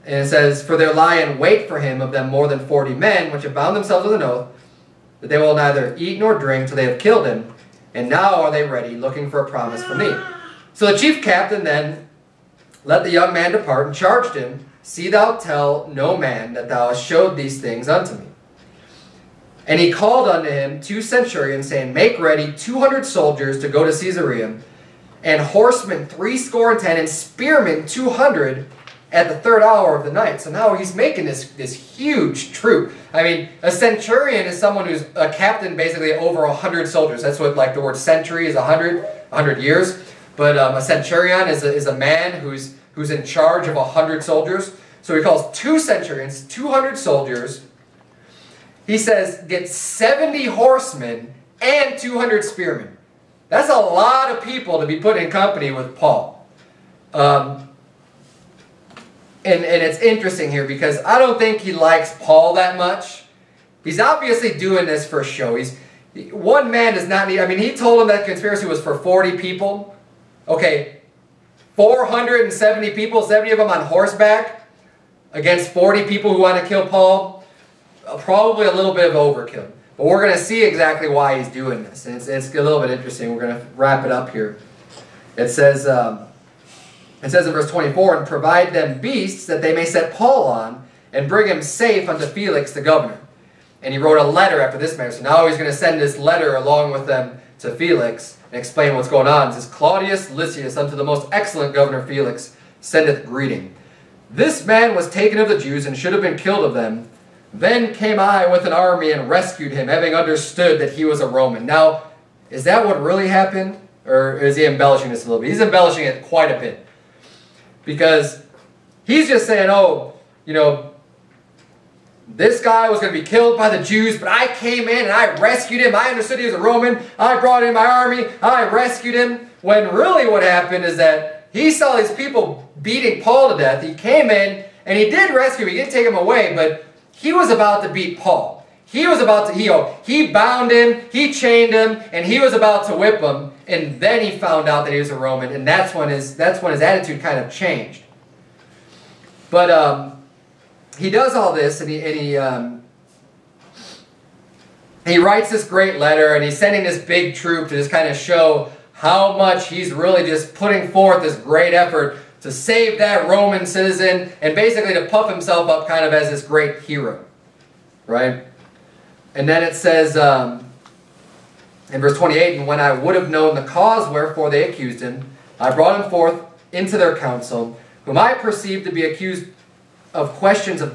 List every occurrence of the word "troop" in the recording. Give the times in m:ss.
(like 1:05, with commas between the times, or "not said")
0:32, 2:37.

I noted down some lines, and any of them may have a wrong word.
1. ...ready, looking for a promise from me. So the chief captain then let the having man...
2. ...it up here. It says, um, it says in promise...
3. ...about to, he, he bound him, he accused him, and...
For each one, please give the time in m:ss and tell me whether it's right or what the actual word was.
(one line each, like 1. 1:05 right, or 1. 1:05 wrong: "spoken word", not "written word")
1. 0:08 wrong: "young", not "having"
2. 1:24 wrong: "verse", not "promise"
3. 2:19 wrong: "chained", not "accused".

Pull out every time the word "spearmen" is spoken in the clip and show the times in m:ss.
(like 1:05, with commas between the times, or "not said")
0:27, 0:52.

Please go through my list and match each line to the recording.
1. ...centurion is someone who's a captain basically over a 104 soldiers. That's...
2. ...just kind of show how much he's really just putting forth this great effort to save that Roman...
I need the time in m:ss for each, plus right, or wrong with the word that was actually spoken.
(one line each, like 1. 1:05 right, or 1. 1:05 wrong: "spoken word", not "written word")
1. 0:33 wrong: "100", not "104"
2. 2:37 right.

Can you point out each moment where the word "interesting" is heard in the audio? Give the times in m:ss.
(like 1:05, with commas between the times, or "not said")
0:59, 1:22.